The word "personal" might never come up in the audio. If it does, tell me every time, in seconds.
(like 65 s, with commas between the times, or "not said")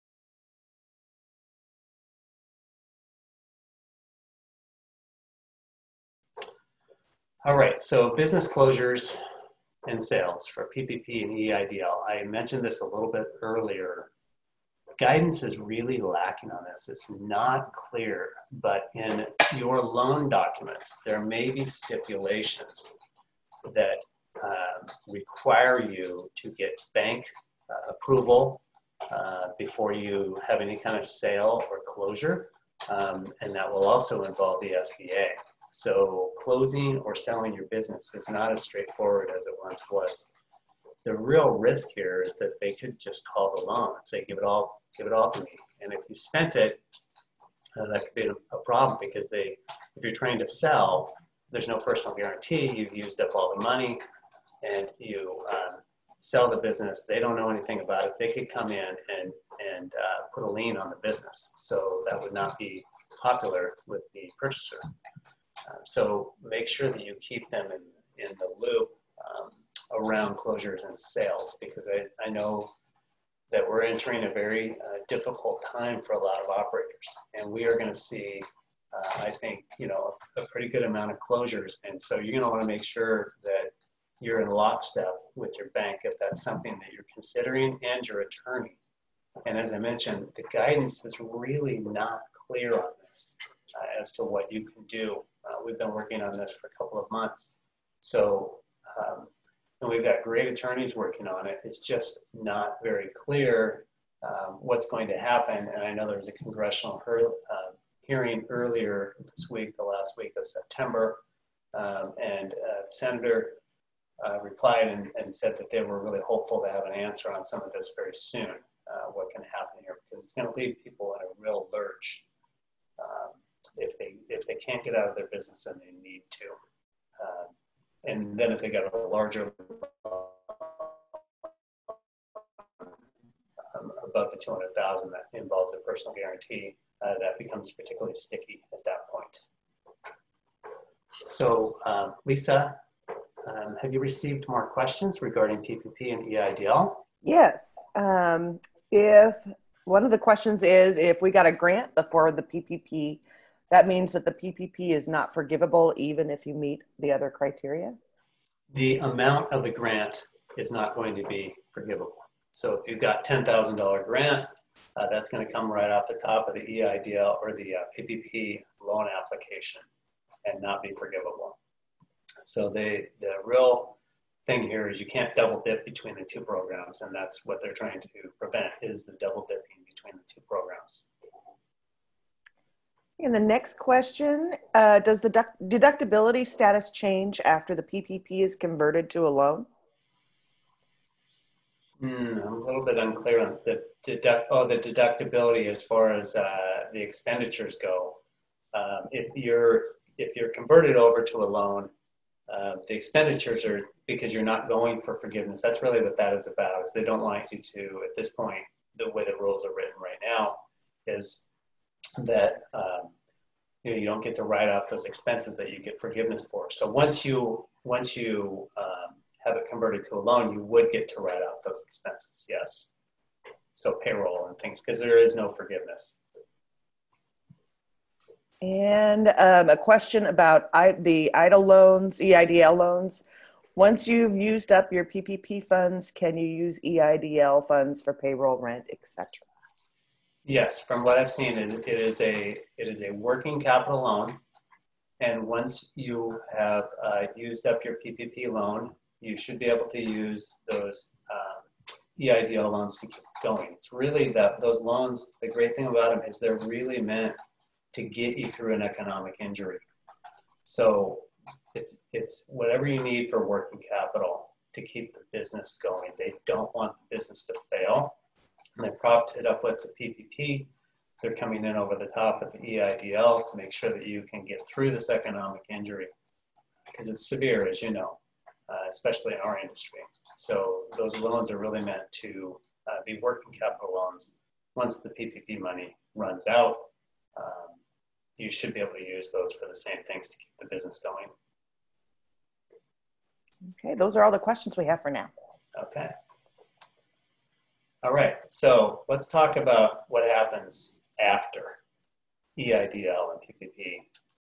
51 s, 135 s.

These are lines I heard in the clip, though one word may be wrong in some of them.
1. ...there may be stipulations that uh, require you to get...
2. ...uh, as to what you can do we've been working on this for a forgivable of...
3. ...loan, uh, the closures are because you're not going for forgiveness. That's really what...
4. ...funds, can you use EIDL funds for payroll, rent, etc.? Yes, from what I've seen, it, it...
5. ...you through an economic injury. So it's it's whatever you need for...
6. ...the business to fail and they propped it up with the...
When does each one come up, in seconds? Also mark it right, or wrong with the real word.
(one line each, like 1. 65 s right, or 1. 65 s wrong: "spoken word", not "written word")
1. 21 s right
2. 93 s wrong: "couple", not "forgivable"
3. 201 s wrong: "expenditures", not "closures"
4. 235 s right
5. 258 s right
6. 266 s right.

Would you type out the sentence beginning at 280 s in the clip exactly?
So those loans are really meant to uh, be working capital loans.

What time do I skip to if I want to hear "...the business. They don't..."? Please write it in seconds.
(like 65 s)
56 s.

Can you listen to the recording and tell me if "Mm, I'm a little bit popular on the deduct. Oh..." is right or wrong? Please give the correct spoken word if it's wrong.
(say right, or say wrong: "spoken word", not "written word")
wrong: "unclear", not "popular".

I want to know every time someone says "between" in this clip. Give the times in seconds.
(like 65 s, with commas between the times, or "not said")
175 s, 179 s.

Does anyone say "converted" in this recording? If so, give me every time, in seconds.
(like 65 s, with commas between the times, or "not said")
188 s, 200 s, 219 s.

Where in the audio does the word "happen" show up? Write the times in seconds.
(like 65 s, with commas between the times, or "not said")
105 s, 119 s, 300 s.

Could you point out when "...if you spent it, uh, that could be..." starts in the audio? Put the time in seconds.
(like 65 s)
45 s.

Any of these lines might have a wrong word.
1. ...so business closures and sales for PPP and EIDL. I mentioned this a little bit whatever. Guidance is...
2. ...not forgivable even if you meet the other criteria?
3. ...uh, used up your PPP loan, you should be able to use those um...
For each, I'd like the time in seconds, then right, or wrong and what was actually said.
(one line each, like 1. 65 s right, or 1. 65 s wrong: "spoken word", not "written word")
1. 7 s wrong: "earlier", not "whatever"
2. 155 s right
3. 247 s right.